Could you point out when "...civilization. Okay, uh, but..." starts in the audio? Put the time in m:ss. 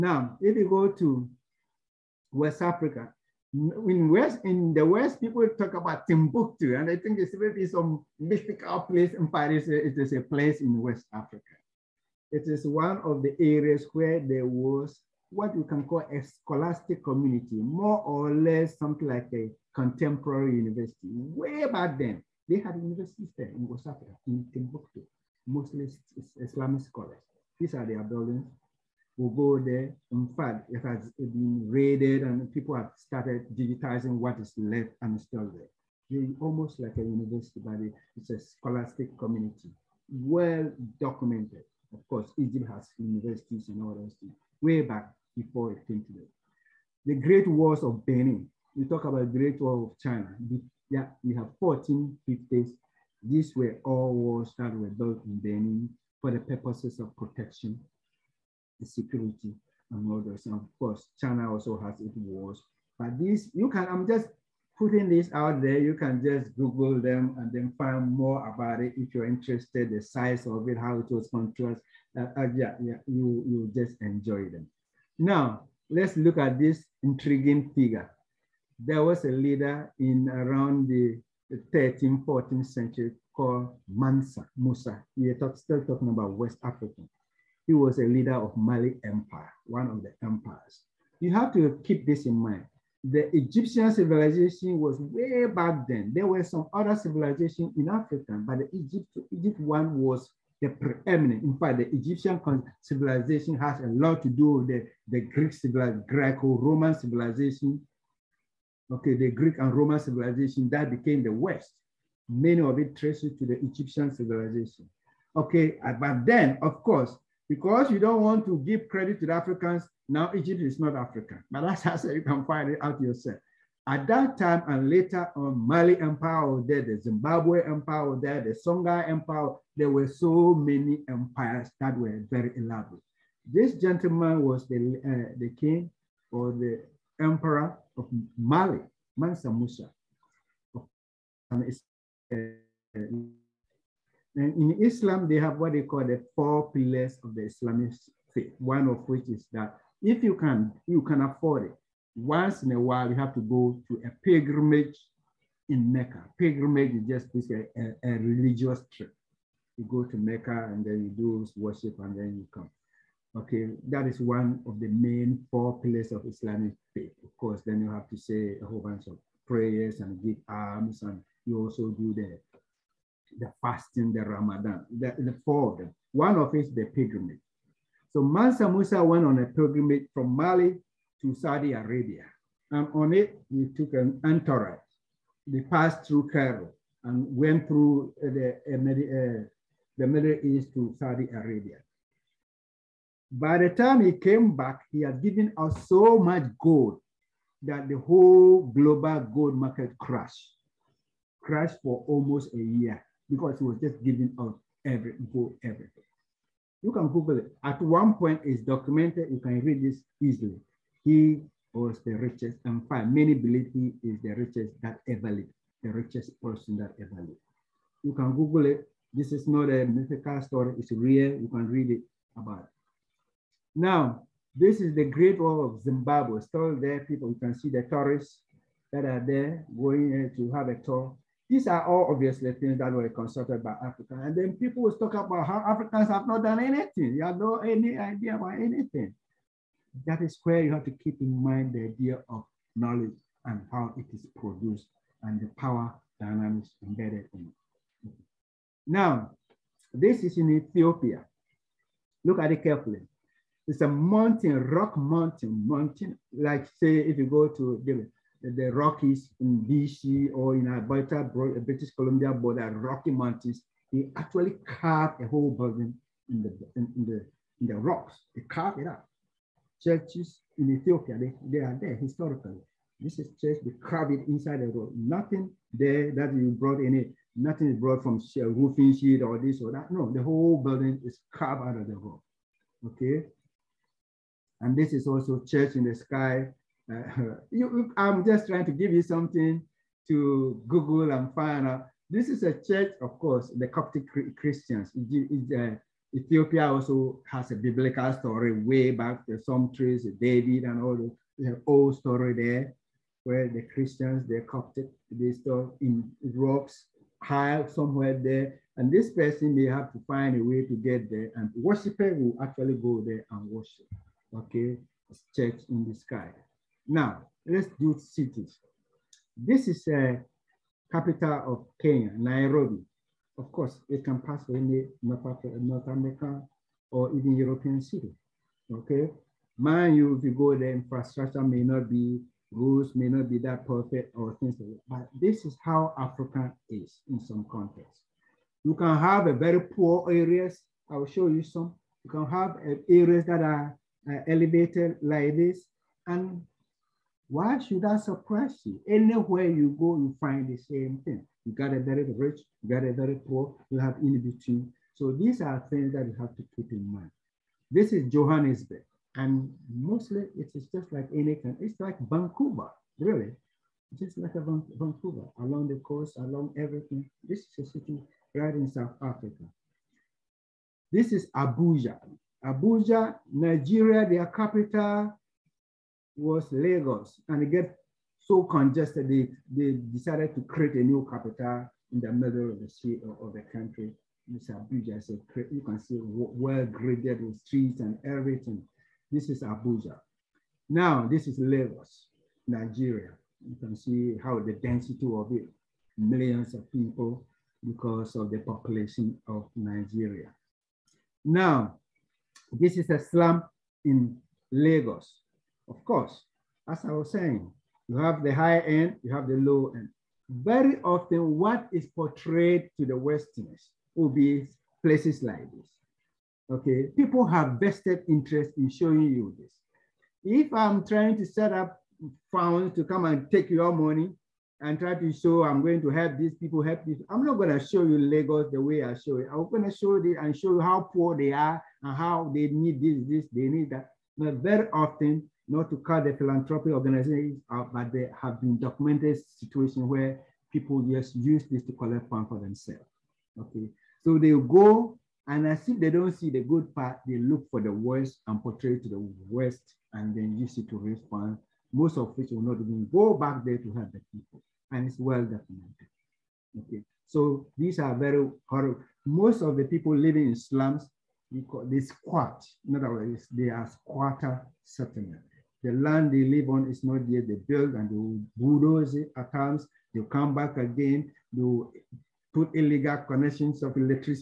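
1:54.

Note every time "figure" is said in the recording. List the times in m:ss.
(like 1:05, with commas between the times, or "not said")
1:17.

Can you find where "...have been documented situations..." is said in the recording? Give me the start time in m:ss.
7:18.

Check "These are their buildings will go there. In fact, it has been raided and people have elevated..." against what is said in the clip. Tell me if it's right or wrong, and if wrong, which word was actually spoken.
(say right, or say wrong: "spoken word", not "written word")
wrong: "started", not "elevated".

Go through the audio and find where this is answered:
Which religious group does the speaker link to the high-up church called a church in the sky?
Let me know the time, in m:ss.
4:53.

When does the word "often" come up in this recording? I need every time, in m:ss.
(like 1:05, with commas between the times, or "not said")
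6:50, 7:14.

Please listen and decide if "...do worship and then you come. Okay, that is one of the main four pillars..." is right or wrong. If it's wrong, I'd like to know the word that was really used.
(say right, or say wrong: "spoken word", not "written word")
right.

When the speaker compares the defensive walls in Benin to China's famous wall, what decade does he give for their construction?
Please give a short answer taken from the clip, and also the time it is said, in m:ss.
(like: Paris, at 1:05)
1450s, at 0:51.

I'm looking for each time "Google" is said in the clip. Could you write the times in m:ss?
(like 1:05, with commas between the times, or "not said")
1:06, 3:27, 3:38, 4:50.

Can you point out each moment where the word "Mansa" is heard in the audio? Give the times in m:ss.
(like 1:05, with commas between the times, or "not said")
1:23, 2:19, 2:58.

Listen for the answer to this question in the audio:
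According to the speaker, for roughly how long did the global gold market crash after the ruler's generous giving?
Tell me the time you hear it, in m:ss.
3:22.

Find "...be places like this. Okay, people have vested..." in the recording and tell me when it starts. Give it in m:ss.
6:54.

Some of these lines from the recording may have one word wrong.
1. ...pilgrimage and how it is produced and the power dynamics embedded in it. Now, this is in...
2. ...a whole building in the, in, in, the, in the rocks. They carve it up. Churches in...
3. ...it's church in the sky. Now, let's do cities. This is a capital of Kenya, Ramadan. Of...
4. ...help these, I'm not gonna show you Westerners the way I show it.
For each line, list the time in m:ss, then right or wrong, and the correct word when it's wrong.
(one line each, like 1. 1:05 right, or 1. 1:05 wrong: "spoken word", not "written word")
1. 4:02 wrong: "knowledge", not "pilgrimage"
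2. 4:25 right
3. 5:15 wrong: "Nairobi", not "Ramadan"
4. 7:06 wrong: "Lagos", not "Westerners".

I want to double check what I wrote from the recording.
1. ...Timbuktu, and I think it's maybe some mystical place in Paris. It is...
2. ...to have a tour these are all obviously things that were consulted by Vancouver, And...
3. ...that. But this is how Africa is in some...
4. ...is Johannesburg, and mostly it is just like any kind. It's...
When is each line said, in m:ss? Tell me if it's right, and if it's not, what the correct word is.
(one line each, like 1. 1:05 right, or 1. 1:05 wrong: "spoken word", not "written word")
1. 0:06 right
2. 3:50 wrong: "Africa", not "Vancouver"
3. 5:34 right
4. 5:57 right.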